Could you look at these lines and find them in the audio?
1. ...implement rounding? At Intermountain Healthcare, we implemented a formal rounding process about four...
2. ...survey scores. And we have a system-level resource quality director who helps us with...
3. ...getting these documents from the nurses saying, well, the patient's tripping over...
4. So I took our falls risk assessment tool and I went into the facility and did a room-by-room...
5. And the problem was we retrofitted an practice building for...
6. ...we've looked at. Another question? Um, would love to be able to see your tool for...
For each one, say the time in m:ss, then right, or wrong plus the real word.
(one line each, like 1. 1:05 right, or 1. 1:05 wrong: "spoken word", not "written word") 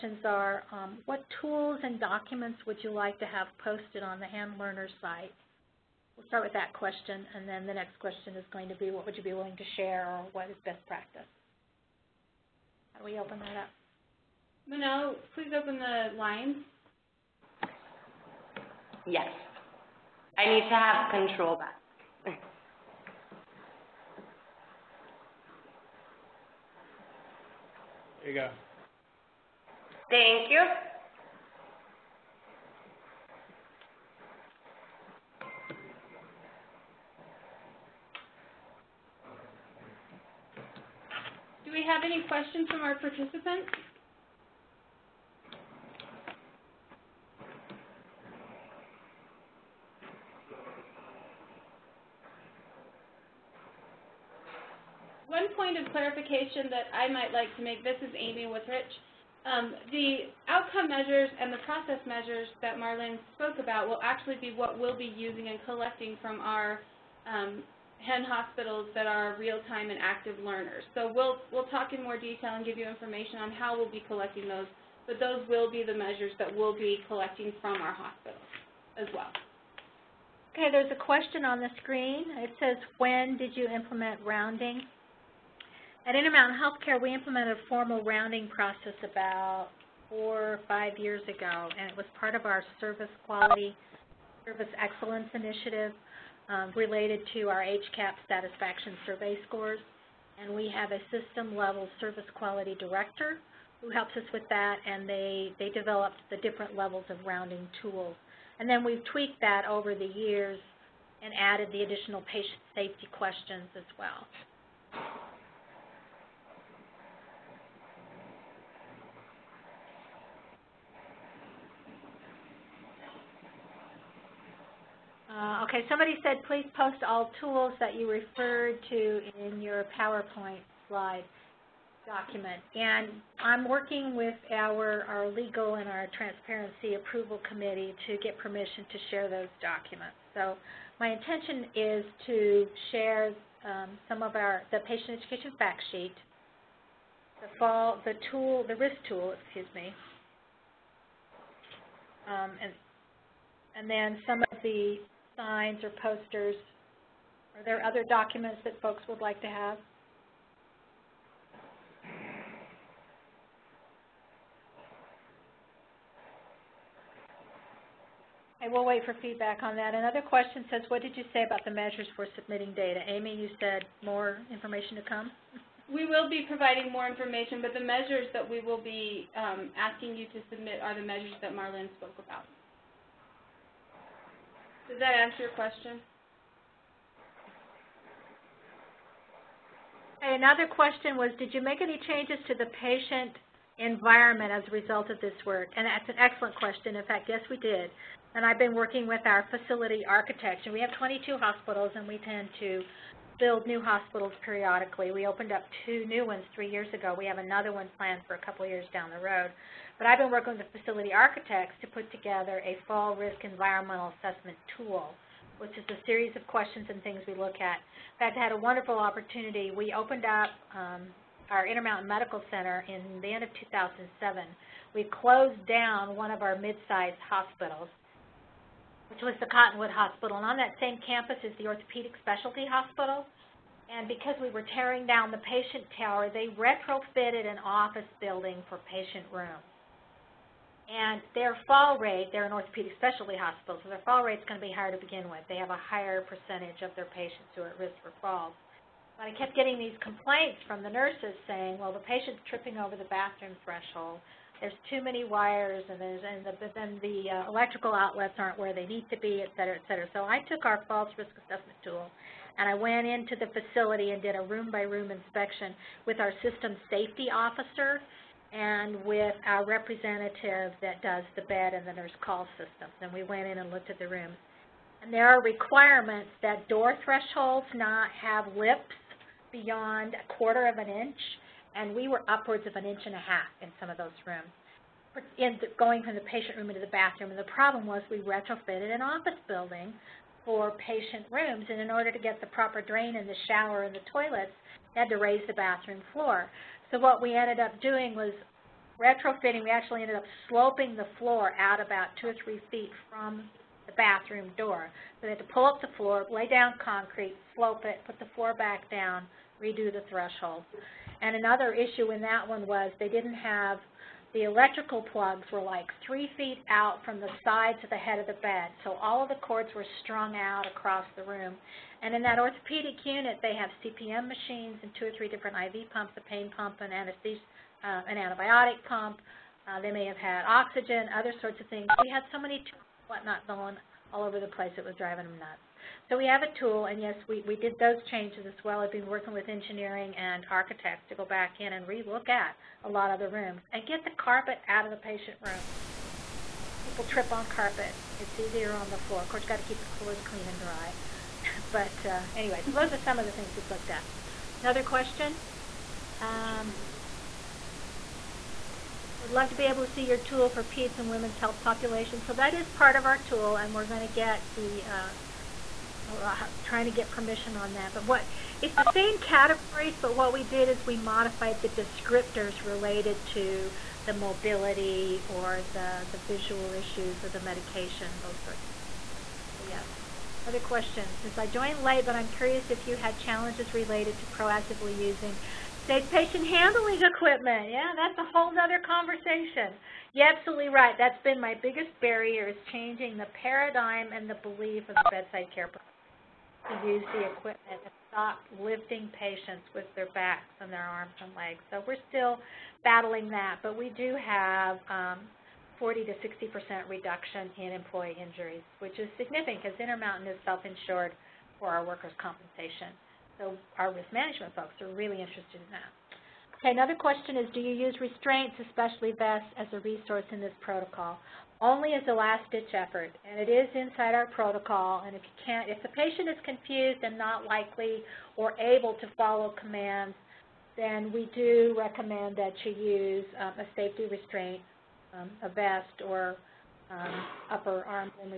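1. 1:23 right
2. 1:39 wrong: "service", not "resource"
3. 4:09 wrong: "complaints", not "documents"
4. 4:20 right
5. 4:47 wrong: "office", not "practice"
6. 5:53 right.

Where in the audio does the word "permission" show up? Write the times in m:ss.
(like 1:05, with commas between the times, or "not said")
2:18, 6:07.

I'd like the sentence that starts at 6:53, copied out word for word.
So our risk management folks are really interested in that.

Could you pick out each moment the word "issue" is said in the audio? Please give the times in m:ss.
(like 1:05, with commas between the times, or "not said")
5:11, 6:16.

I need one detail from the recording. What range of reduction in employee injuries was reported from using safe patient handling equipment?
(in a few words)
40 to 60%.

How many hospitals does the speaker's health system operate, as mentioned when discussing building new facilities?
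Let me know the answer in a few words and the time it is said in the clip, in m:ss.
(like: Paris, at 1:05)
22, at 3:20.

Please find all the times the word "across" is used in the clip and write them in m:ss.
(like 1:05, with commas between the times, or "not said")
5:20.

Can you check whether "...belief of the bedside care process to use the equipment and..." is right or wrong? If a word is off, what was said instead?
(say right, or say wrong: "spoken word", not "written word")
right.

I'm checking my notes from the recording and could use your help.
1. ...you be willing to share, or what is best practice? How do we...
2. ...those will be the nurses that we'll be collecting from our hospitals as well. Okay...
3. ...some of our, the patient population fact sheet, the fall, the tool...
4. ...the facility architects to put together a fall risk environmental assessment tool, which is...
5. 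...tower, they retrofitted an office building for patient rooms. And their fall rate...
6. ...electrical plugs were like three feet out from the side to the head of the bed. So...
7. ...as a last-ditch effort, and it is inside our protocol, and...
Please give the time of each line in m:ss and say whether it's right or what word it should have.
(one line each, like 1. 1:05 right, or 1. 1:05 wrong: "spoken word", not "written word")
1. 0:09 right
2. 1:15 wrong: "measures", not "nurses"
3. 2:24 wrong: "education", not "population"
4. 3:30 right
5. 3:55 right
6. 5:14 right
7. 7:01 right.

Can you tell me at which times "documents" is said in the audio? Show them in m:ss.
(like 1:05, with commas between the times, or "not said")
0:02, 2:12, 2:19, 2:38.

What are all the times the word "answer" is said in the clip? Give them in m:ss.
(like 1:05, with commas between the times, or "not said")
3:05.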